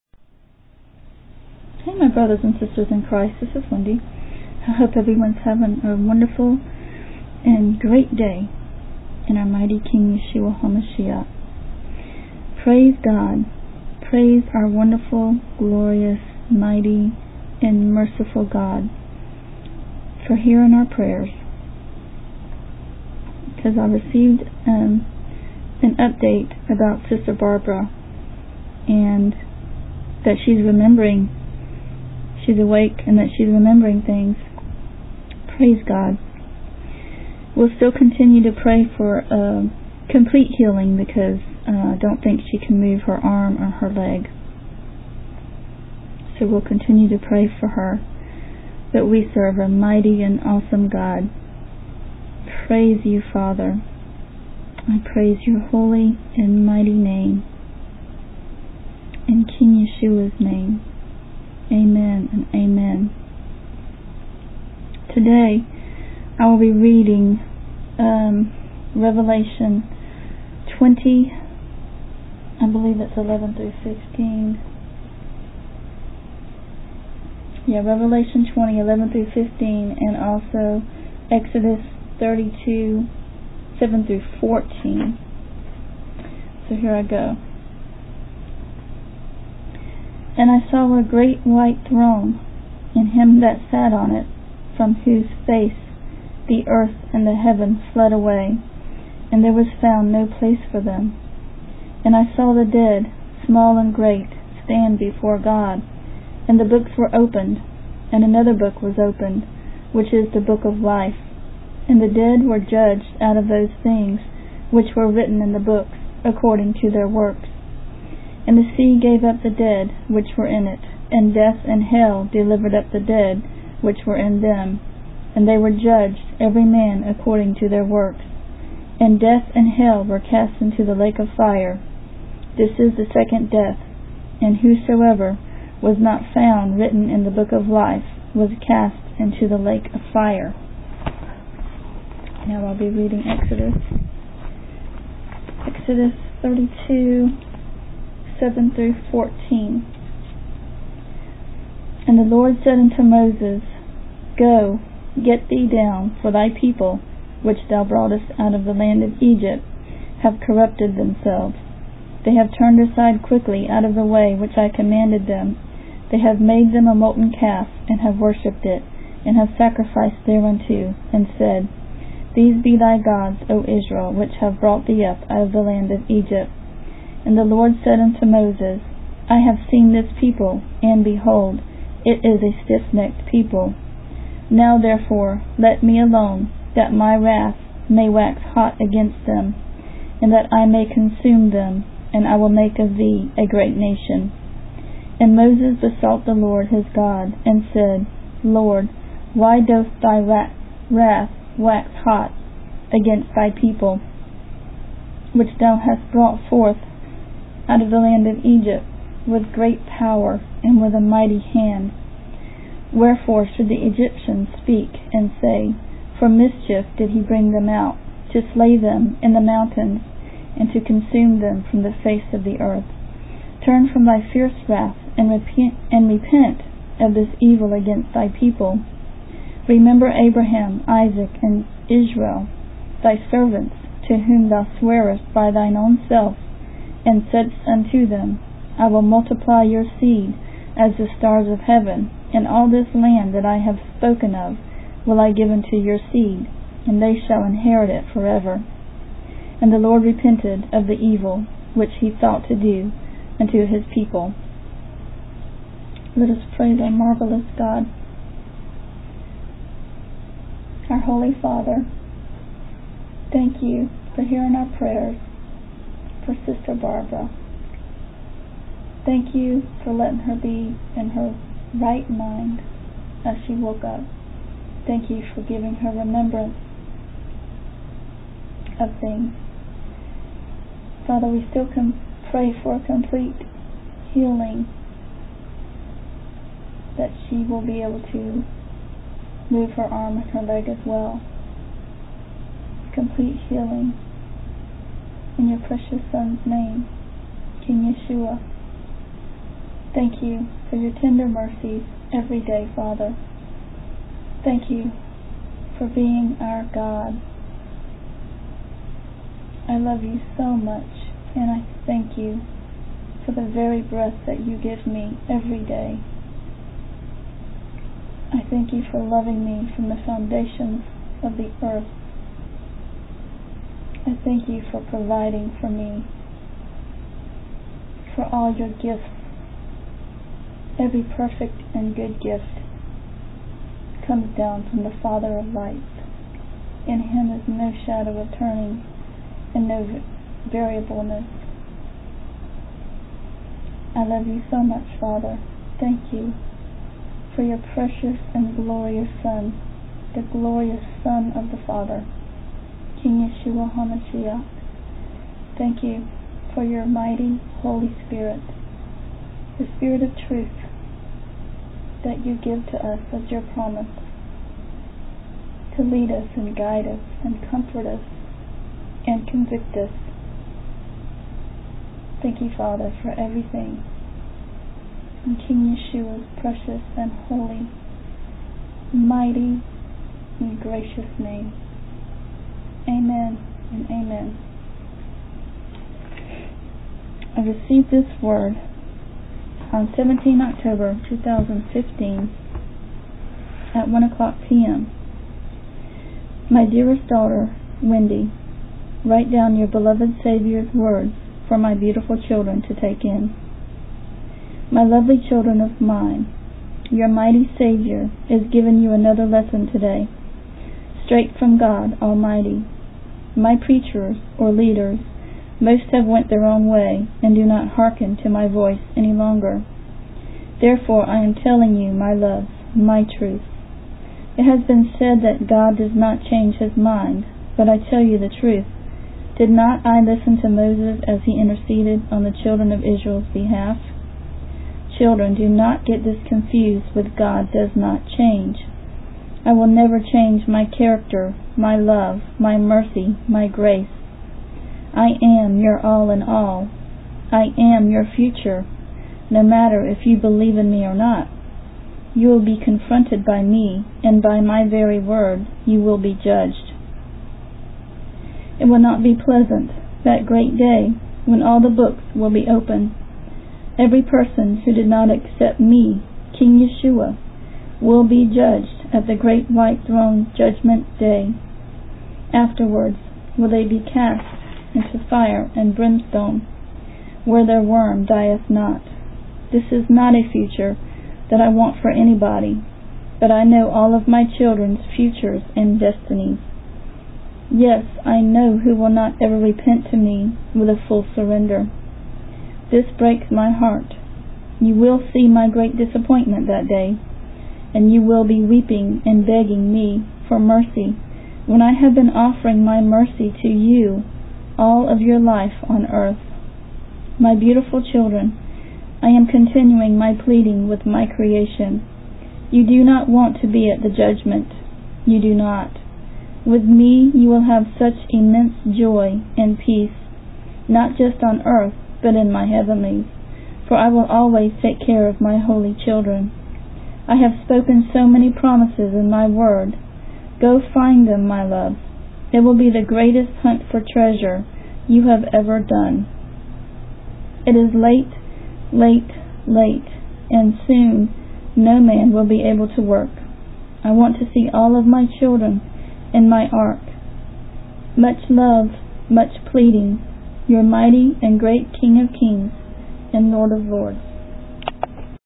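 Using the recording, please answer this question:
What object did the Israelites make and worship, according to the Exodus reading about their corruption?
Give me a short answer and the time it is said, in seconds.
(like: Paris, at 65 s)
a molten calf, at 166 s.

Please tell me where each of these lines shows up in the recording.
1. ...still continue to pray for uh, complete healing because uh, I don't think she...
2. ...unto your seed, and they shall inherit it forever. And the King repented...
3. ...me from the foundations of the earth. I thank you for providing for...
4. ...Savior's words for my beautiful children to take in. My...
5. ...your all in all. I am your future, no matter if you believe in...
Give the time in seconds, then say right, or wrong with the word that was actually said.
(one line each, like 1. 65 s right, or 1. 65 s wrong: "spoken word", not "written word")
1. 37 s right
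2. 245 s wrong: "Lord", not "King"
3. 319 s right
4. 400 s right
5. 445 s right.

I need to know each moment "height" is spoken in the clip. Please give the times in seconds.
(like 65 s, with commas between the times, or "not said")
not said.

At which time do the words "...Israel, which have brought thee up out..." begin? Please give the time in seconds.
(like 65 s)
173 s.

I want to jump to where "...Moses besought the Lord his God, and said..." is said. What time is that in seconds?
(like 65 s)
195 s.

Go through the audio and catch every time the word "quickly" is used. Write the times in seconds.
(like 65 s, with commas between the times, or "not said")
163 s.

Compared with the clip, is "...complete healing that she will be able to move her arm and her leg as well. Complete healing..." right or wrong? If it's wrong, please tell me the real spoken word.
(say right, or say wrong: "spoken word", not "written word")
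right.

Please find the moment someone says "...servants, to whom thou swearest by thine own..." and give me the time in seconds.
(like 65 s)
233 s.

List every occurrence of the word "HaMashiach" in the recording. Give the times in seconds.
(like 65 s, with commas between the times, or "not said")
10 s, 353 s.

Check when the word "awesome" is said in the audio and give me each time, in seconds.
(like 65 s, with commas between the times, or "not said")
50 s.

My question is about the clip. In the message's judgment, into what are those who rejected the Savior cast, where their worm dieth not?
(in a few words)
fire and brimstone.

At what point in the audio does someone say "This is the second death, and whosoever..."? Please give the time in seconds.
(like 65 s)
132 s.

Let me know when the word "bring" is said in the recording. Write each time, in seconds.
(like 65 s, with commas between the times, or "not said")
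217 s.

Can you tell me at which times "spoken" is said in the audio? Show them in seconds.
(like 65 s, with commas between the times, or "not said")
243 s, 527 s.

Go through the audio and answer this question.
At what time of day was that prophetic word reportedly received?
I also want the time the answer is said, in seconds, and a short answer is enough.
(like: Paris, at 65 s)
1 p.m., at 393 s.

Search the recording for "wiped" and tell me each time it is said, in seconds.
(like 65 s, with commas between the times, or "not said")
not said.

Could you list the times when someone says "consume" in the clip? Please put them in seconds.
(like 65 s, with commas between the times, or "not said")
190 s, 220 s.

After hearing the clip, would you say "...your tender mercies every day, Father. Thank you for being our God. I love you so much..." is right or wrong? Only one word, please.
right.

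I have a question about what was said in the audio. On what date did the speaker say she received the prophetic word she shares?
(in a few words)
17 October 2015.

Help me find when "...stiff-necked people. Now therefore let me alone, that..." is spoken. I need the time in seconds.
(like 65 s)
182 s.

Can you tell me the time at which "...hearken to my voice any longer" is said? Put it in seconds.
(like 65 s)
417 s.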